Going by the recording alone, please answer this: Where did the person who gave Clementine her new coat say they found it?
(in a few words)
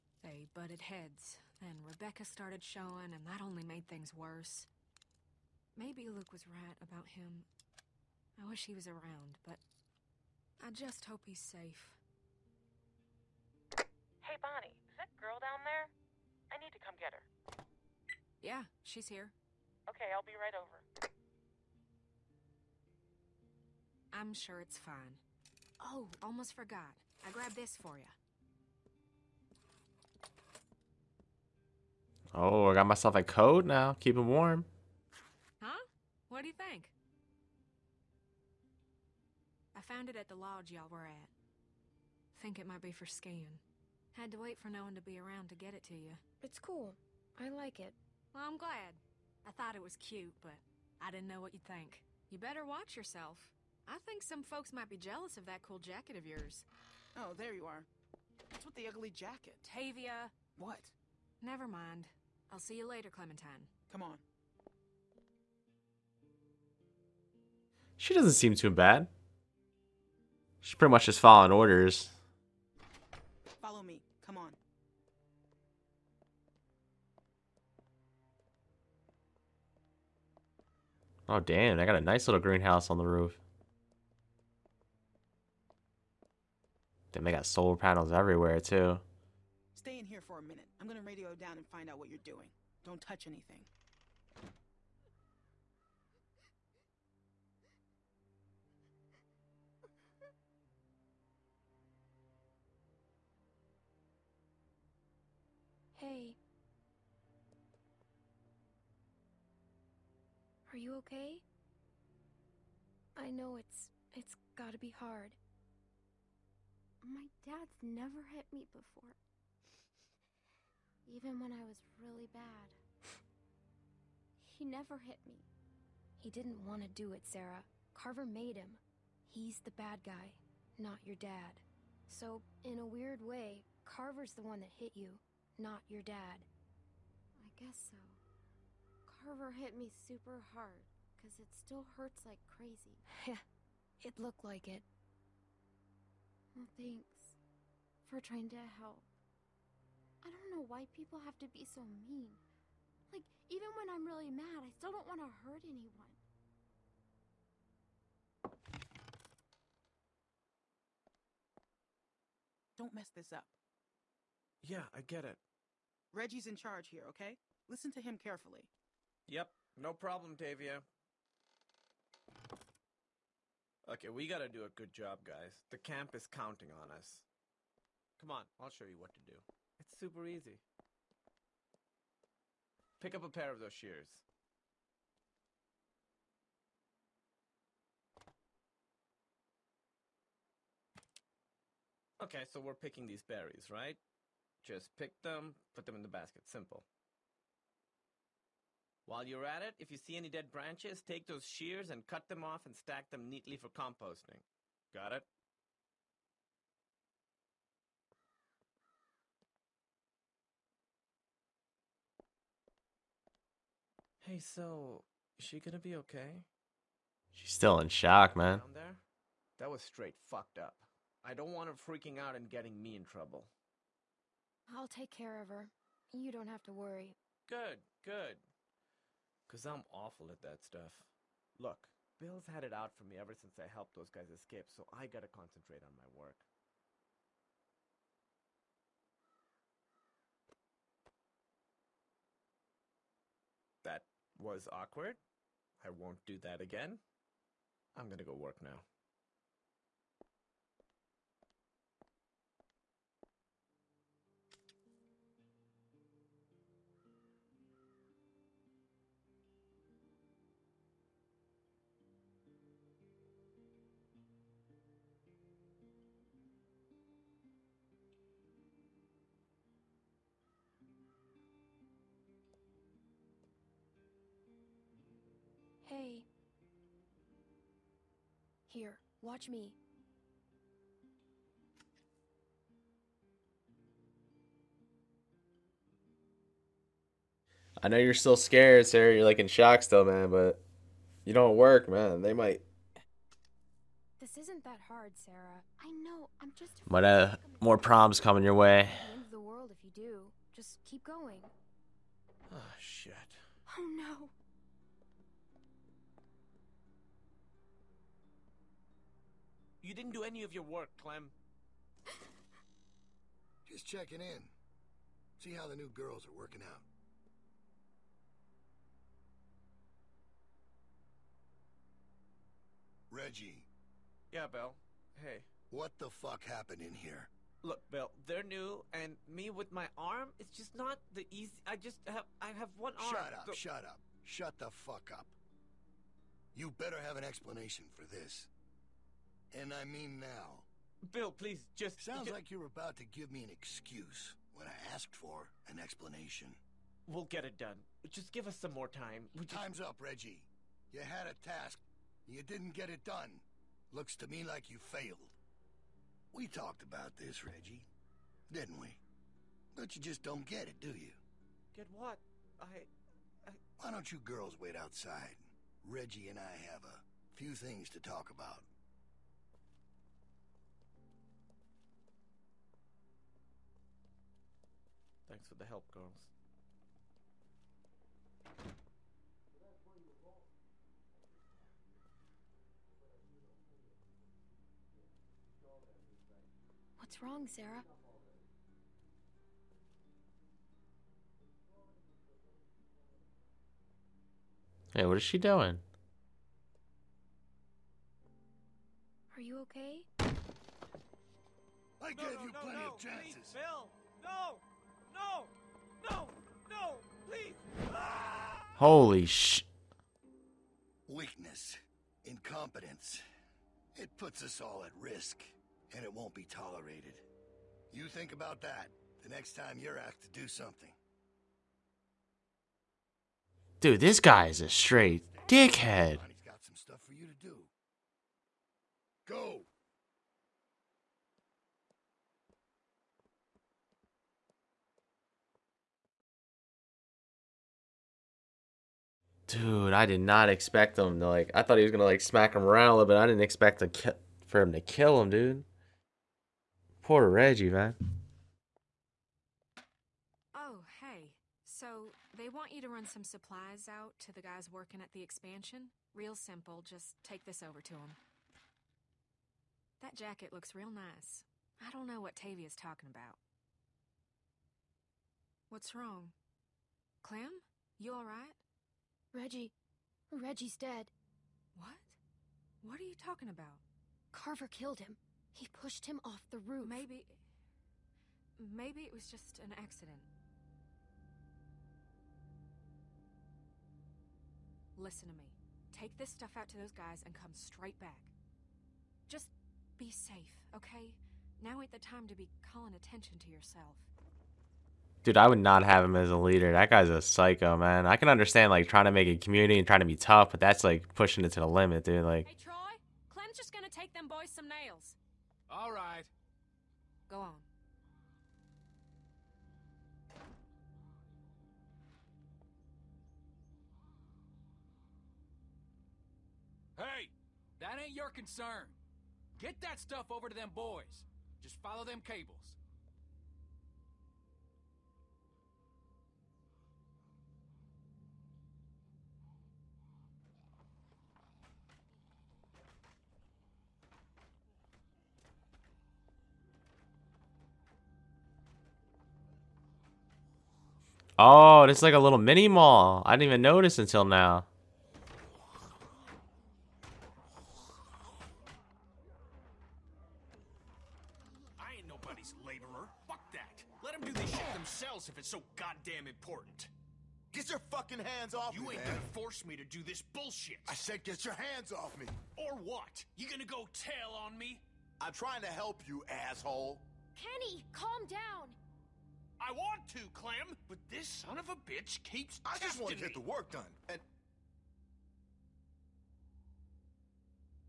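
The lodge.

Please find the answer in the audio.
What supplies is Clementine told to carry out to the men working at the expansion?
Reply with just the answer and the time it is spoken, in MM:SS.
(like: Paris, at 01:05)
Nails, at 08:24.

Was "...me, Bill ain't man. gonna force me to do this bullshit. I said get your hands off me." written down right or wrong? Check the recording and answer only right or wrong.
wrong.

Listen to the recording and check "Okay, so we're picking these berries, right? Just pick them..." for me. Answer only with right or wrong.
right.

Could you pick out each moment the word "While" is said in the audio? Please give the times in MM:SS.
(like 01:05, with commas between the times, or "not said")
03:19.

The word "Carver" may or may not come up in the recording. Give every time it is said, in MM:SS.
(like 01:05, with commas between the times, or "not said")
02:07, 02:13, 02:19, 07:54.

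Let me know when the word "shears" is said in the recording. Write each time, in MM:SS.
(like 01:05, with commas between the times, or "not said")
03:03, 03:21.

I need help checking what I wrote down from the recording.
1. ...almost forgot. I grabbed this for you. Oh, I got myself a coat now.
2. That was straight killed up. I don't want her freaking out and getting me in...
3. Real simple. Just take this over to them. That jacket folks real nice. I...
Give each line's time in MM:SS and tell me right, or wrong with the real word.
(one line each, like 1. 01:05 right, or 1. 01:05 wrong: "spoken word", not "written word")
1. 00:26 right
2. 03:39 wrong: "fucked", not "killed"
3. 07:36 wrong: "looks", not "folks".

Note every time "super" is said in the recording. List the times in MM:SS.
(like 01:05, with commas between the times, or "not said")
02:20, 02:59.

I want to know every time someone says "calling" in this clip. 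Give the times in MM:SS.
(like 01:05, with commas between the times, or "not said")
08:12.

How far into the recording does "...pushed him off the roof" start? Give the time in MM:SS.
07:55.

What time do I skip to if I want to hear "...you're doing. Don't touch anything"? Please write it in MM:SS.
01:32.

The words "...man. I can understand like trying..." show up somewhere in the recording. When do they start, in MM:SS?
08:17.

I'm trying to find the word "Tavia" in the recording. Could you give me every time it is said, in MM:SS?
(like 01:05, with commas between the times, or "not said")
00:59, 02:50, 07:42.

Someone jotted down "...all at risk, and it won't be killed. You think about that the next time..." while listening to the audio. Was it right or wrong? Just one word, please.
wrong.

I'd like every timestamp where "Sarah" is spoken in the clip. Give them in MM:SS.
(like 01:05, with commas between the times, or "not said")
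02:07, 04:48, 04:55, 06:27.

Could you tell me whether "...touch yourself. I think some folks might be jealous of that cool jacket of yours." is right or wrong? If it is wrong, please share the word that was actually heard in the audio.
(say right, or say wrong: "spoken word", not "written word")
wrong: "watch", not "touch".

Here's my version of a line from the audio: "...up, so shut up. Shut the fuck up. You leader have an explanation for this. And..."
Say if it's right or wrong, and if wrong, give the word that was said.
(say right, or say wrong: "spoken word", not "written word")
wrong: "better", not "leader".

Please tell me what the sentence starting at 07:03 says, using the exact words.
Dude, this guy is a straight dickhead.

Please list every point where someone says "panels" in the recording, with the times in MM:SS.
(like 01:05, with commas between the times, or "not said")
01:27.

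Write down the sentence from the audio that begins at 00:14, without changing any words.
Hey, Bonnie, is that girl down there?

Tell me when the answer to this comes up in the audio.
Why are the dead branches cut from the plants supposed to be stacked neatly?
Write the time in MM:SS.
03:23.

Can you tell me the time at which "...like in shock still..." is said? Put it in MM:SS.
04:49.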